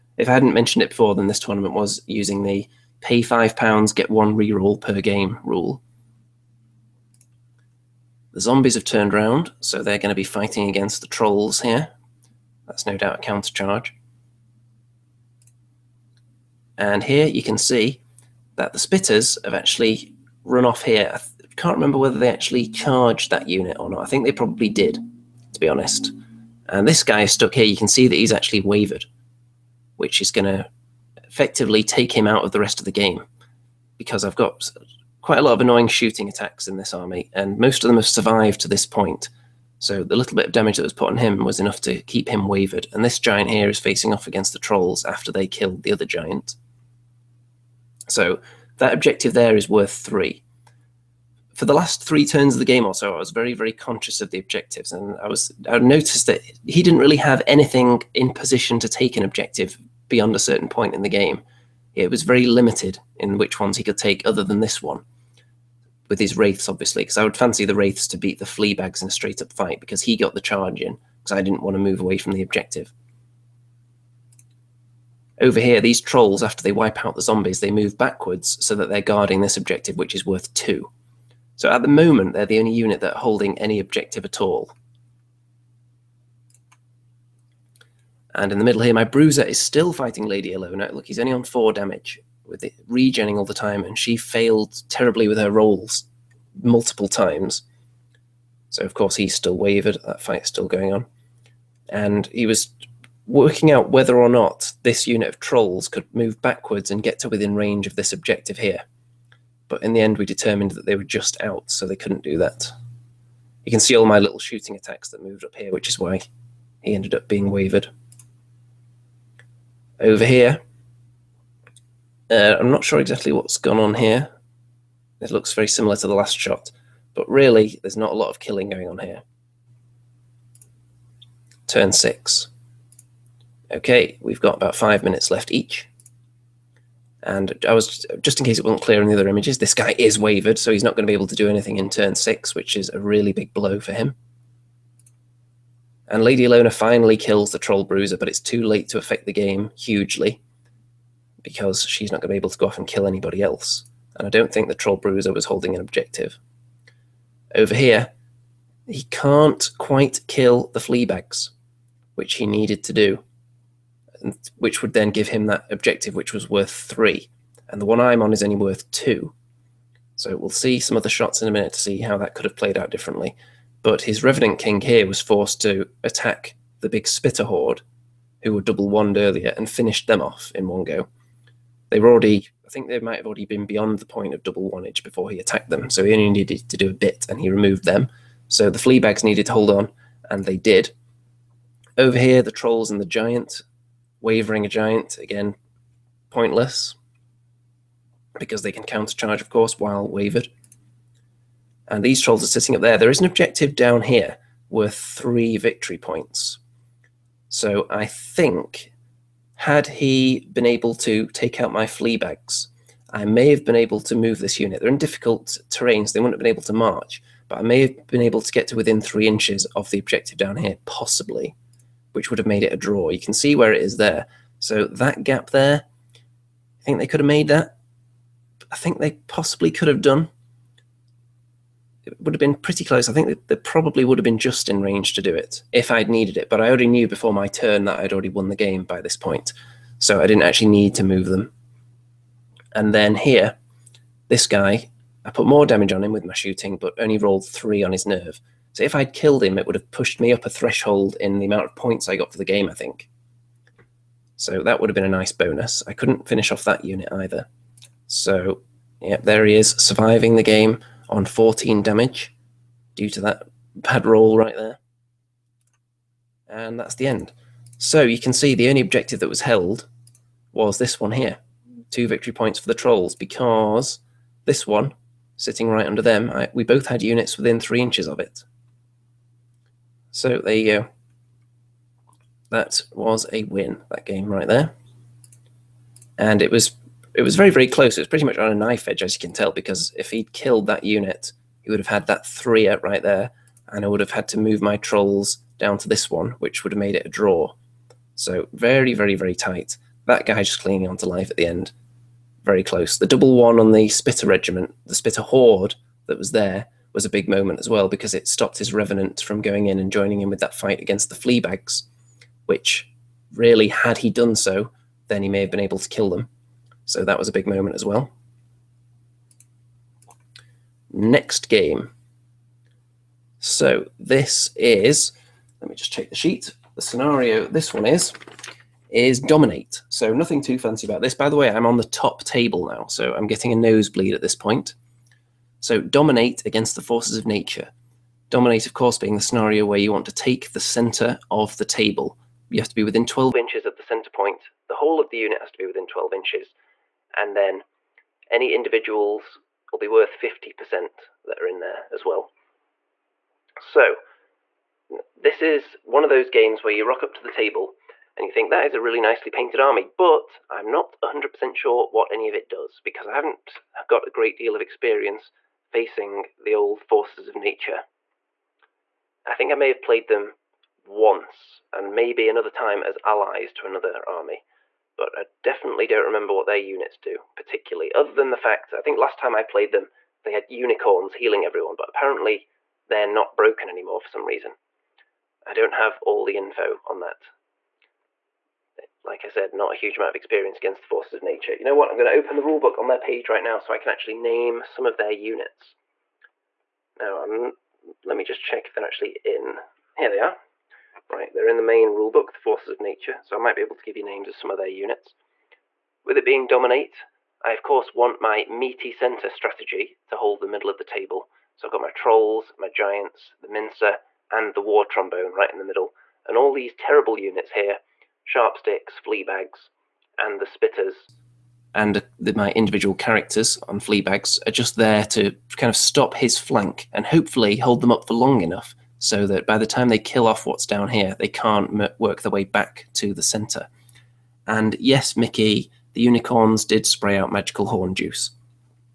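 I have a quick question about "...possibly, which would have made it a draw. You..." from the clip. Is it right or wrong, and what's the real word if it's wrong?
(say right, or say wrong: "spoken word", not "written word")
right.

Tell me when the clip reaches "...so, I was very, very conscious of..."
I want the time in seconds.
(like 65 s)
52 s.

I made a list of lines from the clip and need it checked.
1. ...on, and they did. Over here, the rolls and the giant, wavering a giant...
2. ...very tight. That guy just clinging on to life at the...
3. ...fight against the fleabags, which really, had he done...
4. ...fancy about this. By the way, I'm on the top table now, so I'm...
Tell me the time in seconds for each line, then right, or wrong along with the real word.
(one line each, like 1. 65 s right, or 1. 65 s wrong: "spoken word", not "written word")
1. 189 s wrong: "trolls", not "rolls"
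2. 299 s right
3. 310 s right
4. 330 s right.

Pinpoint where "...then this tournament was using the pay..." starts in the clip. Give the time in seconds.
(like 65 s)
1 s.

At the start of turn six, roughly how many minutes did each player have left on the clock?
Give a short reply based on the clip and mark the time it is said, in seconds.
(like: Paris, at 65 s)
5, at 134 s.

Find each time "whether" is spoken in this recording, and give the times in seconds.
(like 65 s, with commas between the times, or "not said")
21 s, 103 s.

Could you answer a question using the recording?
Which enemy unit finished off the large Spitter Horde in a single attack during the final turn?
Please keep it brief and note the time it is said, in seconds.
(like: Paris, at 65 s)
Revenant King, at 174 s.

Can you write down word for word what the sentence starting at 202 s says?
There is an objective down here worth three victory points.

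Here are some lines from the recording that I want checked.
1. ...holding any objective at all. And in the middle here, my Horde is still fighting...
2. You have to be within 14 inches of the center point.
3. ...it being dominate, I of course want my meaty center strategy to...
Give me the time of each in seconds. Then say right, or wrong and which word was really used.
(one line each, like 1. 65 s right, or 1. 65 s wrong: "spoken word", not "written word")
1. 83 s wrong: "Bruiser", not "Horde"
2. 342 s wrong: "12", not "14"
3. 406 s right.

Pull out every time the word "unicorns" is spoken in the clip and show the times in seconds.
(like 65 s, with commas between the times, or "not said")
380 s, 436 s.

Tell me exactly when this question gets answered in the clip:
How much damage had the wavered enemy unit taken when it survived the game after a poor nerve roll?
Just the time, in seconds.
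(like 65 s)
261 s.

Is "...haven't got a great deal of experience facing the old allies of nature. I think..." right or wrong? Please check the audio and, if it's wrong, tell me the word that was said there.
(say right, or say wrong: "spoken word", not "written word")
wrong: "forces", not "allies".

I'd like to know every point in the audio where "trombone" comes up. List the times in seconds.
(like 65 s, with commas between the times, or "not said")
414 s.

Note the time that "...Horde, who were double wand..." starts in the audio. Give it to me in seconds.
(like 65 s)
177 s.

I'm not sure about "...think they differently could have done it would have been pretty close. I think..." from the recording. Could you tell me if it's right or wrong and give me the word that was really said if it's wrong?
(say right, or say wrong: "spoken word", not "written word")
wrong: "possibly", not "differently".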